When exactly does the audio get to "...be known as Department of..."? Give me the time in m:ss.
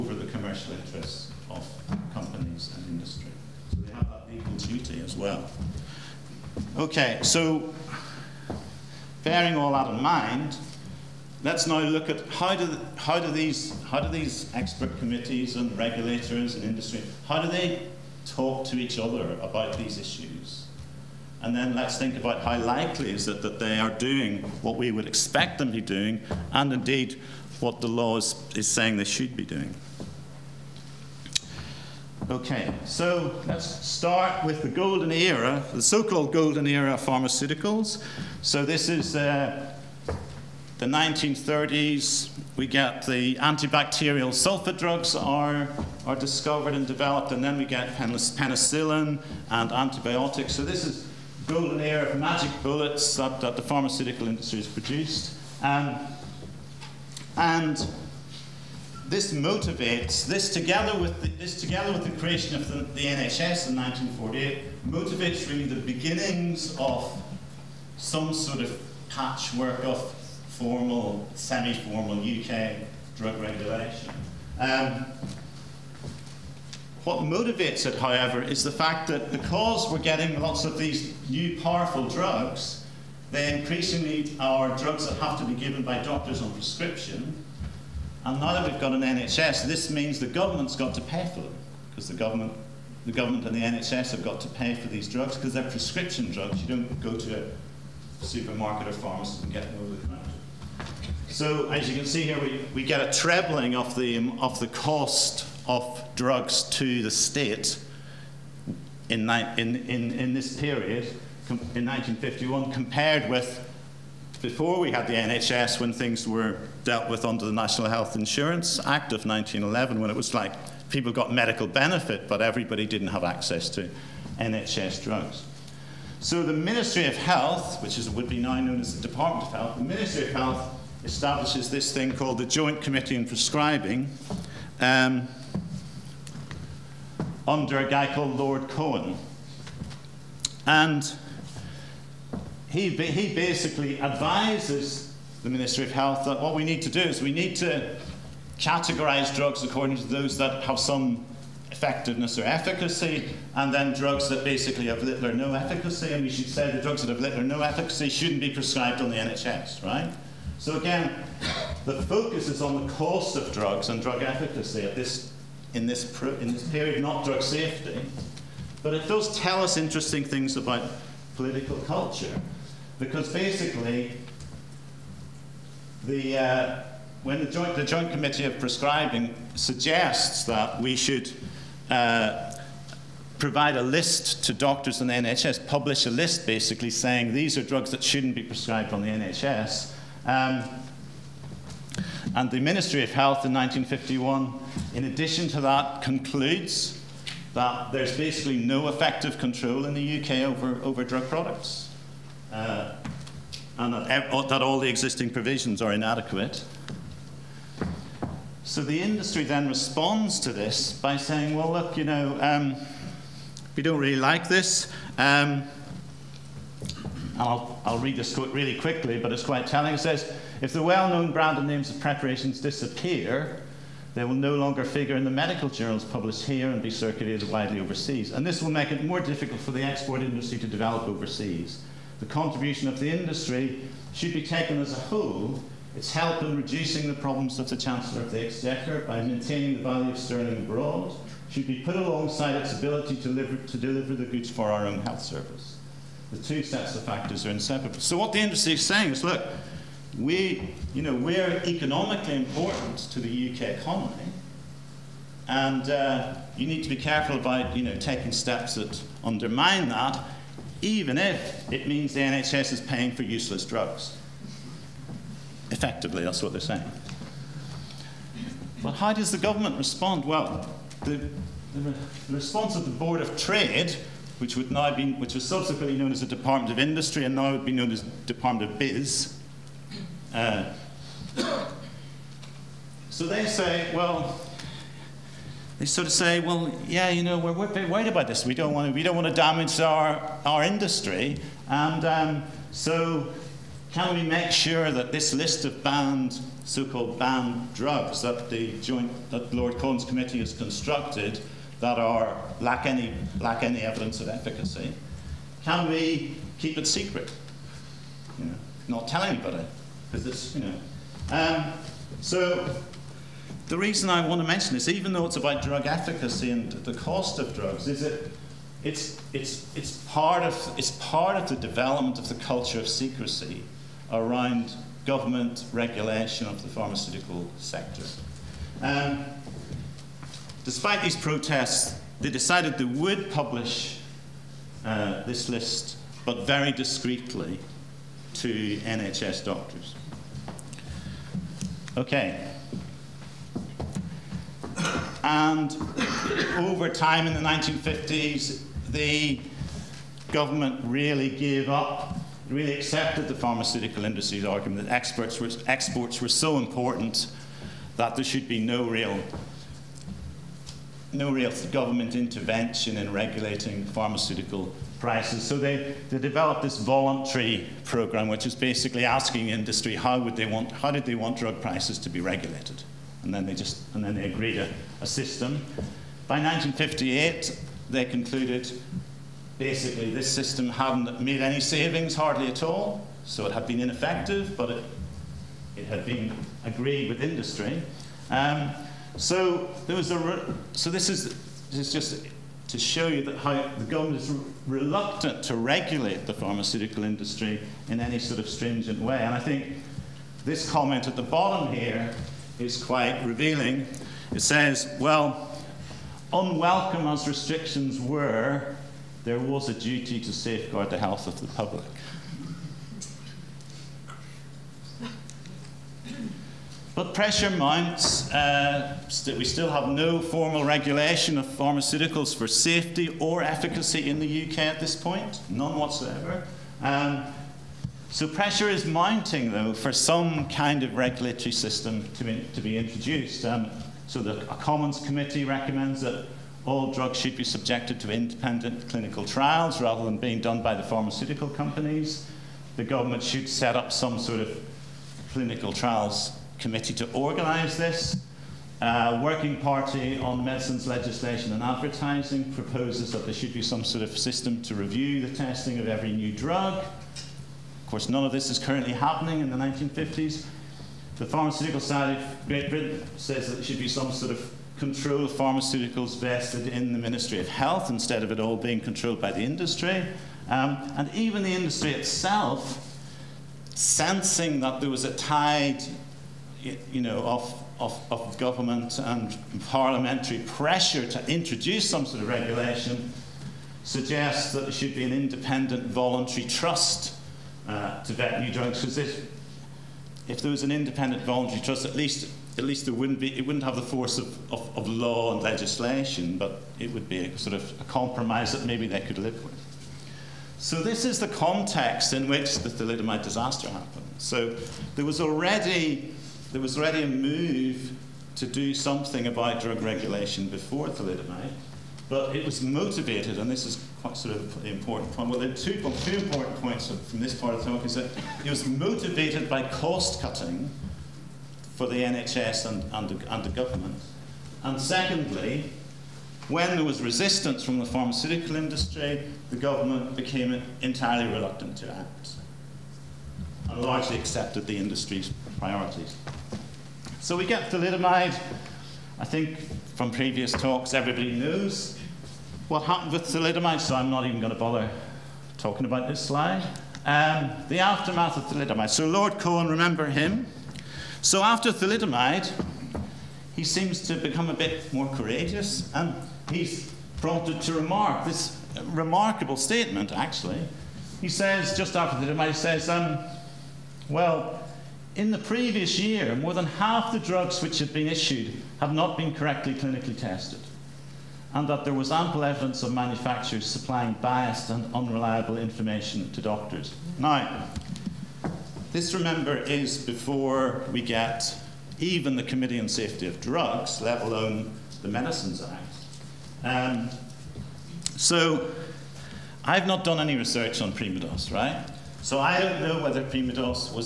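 4:37.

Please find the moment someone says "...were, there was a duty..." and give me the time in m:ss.
6:47.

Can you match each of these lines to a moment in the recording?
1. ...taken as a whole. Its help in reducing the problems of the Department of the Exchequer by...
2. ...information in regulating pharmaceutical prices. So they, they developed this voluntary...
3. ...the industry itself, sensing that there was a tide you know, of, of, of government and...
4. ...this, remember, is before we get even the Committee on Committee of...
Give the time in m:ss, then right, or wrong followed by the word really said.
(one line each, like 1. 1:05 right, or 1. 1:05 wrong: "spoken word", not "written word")
1. 3:54 wrong: "Chancellor", not "Department"
2. 6:02 wrong: "intervention", not "information"
3. 7:51 right
4. 9:38 wrong: "Safety", not "Committee".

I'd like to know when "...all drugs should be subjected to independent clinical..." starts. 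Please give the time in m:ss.
7:16.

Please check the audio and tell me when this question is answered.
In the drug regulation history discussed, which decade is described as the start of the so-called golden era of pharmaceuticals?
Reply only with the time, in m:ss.
0:40.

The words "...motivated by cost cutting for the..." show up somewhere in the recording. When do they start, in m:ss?
8:38.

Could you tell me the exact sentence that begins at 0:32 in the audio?
Okay, so let's start with the golden era, the so-called golden era of pharmaceuticals.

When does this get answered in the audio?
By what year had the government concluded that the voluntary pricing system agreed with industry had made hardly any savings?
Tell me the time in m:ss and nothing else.
6:16.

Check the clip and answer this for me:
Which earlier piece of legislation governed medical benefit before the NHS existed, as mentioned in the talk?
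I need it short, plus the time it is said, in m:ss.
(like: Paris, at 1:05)
National Health Insurance Act, at 1:57.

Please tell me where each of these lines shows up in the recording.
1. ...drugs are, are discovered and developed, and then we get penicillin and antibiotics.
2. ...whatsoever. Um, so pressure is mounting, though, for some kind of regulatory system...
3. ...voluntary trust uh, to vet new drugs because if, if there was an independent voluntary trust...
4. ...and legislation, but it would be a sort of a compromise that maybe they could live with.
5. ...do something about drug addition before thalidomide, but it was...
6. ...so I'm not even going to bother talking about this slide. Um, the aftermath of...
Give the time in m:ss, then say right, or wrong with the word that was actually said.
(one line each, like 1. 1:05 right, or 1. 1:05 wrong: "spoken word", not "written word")
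1. 0:44 right
2. 7:05 right
3. 8:05 right
4. 8:15 right
5. 8:28 wrong: "regulation", not "addition"
6. 9:03 right.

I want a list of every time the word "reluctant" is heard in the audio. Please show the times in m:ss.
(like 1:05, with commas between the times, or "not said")
6:34, 8:51.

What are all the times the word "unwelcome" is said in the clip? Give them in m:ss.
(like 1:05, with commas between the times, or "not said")
6:46.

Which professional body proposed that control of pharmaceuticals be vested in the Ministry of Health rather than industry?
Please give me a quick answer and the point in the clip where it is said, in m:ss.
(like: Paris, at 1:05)
Pharmaceutical Society of Great Britain, at 7:41.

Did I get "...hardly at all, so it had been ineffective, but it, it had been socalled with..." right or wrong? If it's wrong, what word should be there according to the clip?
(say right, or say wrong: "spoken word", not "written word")
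wrong: "agreed", not "socalled".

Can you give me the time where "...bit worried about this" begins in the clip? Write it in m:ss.
4:47.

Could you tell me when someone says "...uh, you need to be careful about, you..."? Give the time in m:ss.
4:15.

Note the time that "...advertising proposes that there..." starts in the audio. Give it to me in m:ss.
7:31.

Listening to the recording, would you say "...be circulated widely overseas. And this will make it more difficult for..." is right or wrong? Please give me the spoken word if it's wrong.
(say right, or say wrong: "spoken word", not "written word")
right.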